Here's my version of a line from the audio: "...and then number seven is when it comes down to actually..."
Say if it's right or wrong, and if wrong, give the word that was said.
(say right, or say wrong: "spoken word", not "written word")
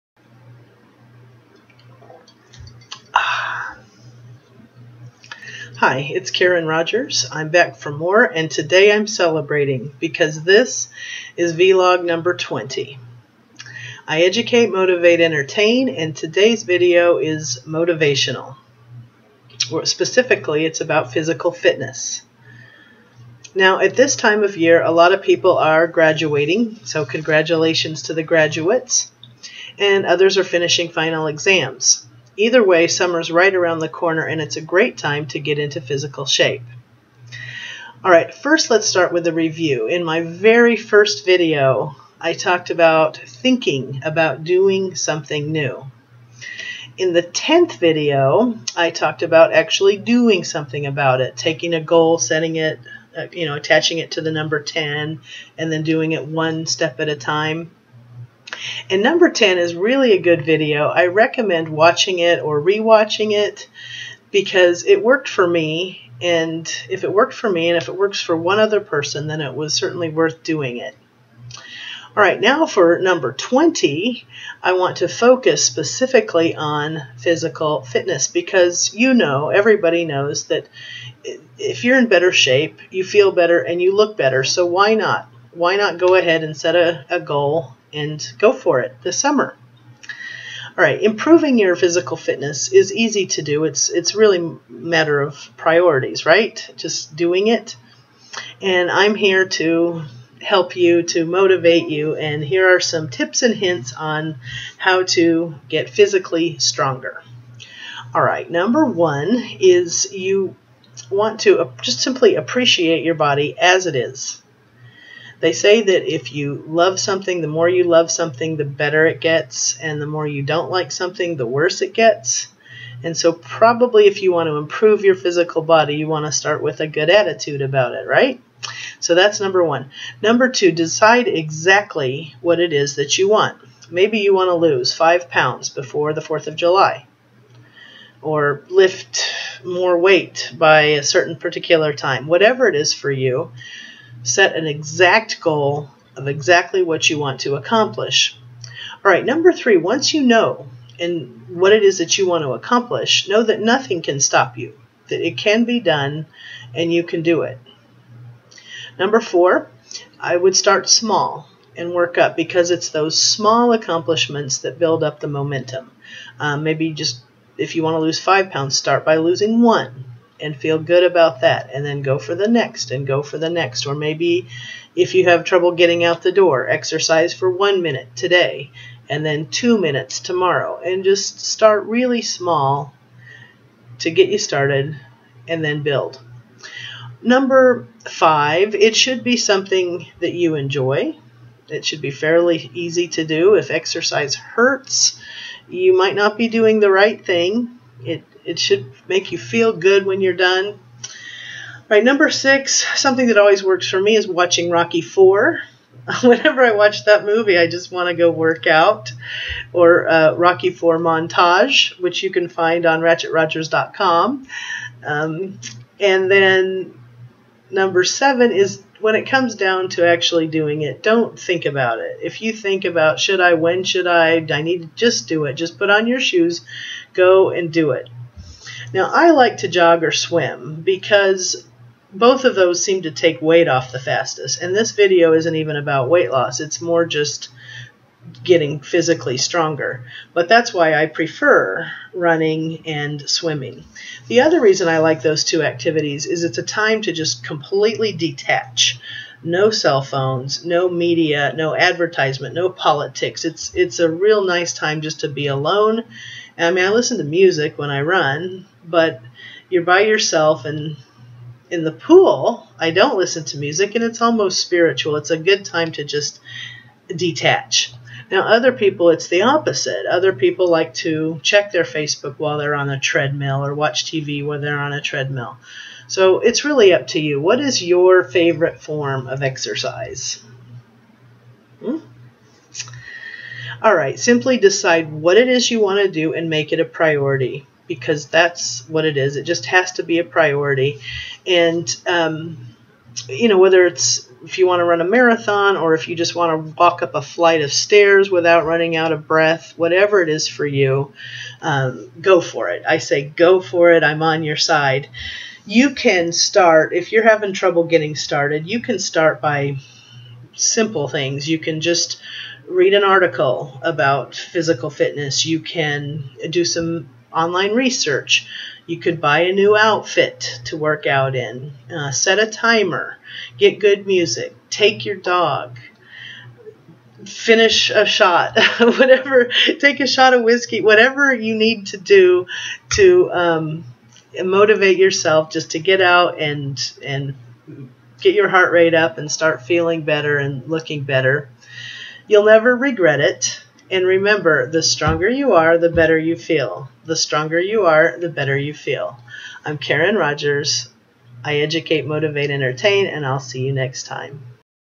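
right.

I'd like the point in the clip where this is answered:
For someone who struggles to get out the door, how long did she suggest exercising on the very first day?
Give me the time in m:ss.
2:57.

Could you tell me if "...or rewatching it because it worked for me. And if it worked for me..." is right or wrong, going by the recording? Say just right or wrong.
right.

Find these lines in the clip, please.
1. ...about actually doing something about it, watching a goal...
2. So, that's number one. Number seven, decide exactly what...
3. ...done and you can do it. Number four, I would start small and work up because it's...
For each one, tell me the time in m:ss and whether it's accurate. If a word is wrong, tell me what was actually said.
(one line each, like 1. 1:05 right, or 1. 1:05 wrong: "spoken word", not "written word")
1. 0:49 wrong: "taking", not "watching"
2. 2:08 wrong: "two", not "seven"
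3. 2:35 right.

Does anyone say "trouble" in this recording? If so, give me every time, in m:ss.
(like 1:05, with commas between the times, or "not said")
2:55, 5:07.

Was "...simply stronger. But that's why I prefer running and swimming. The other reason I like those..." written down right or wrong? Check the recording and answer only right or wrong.
wrong.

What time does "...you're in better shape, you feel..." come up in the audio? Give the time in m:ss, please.
1:21.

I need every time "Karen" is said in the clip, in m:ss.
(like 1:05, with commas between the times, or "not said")
0:06, 5:49.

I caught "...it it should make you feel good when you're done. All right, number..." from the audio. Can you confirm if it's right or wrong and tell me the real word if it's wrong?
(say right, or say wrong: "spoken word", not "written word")
right.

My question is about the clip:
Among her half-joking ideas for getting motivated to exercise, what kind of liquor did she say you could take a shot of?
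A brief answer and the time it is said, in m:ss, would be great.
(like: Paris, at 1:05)
whiskey, at 5:30.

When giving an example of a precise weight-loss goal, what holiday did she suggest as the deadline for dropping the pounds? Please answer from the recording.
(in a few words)
4th of July.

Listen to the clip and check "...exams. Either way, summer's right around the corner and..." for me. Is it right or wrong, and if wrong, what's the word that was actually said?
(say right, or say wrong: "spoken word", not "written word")
right.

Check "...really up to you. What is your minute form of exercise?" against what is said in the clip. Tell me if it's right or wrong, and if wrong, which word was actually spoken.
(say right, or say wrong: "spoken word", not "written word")
wrong: "favorite", not "minute".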